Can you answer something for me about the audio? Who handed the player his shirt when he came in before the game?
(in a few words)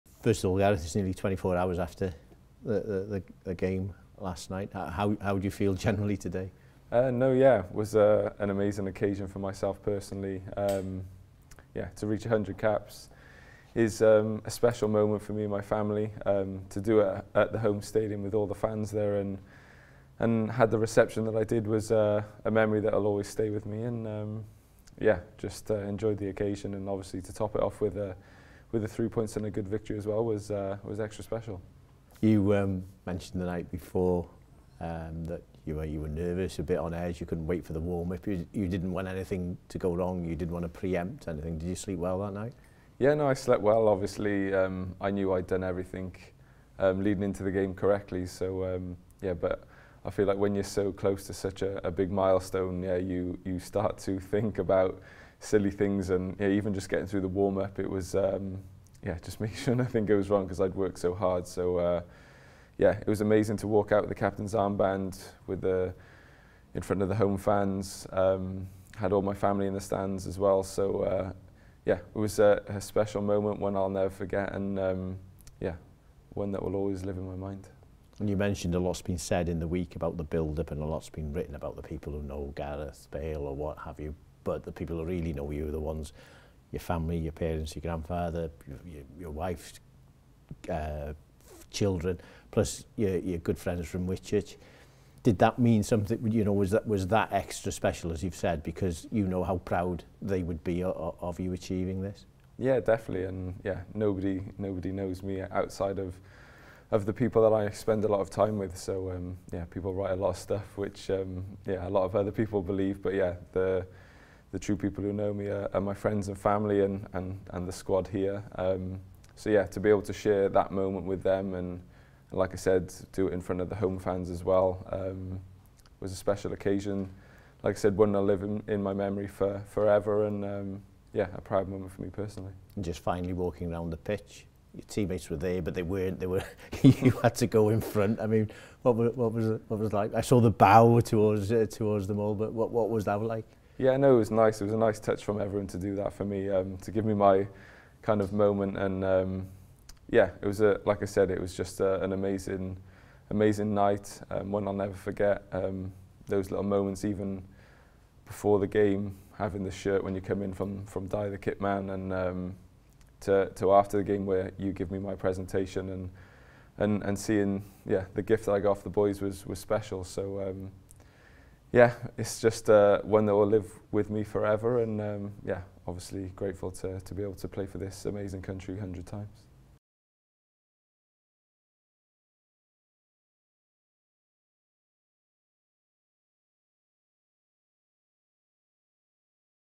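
Dai the Kit Man.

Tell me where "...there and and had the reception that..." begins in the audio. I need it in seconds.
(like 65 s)
18 s.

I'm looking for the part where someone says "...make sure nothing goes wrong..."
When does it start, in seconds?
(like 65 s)
59 s.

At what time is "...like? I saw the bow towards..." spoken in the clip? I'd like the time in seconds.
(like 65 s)
139 s.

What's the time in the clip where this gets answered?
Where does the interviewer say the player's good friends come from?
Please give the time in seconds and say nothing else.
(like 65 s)
94 s.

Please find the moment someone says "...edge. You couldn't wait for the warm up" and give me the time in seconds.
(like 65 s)
36 s.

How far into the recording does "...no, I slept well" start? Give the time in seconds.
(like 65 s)
43 s.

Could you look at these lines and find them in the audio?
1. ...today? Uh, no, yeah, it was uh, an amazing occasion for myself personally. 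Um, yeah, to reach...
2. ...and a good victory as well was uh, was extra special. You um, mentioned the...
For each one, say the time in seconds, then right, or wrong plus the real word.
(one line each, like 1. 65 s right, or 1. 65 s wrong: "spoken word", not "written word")
1. 6 s right
2. 29 s right.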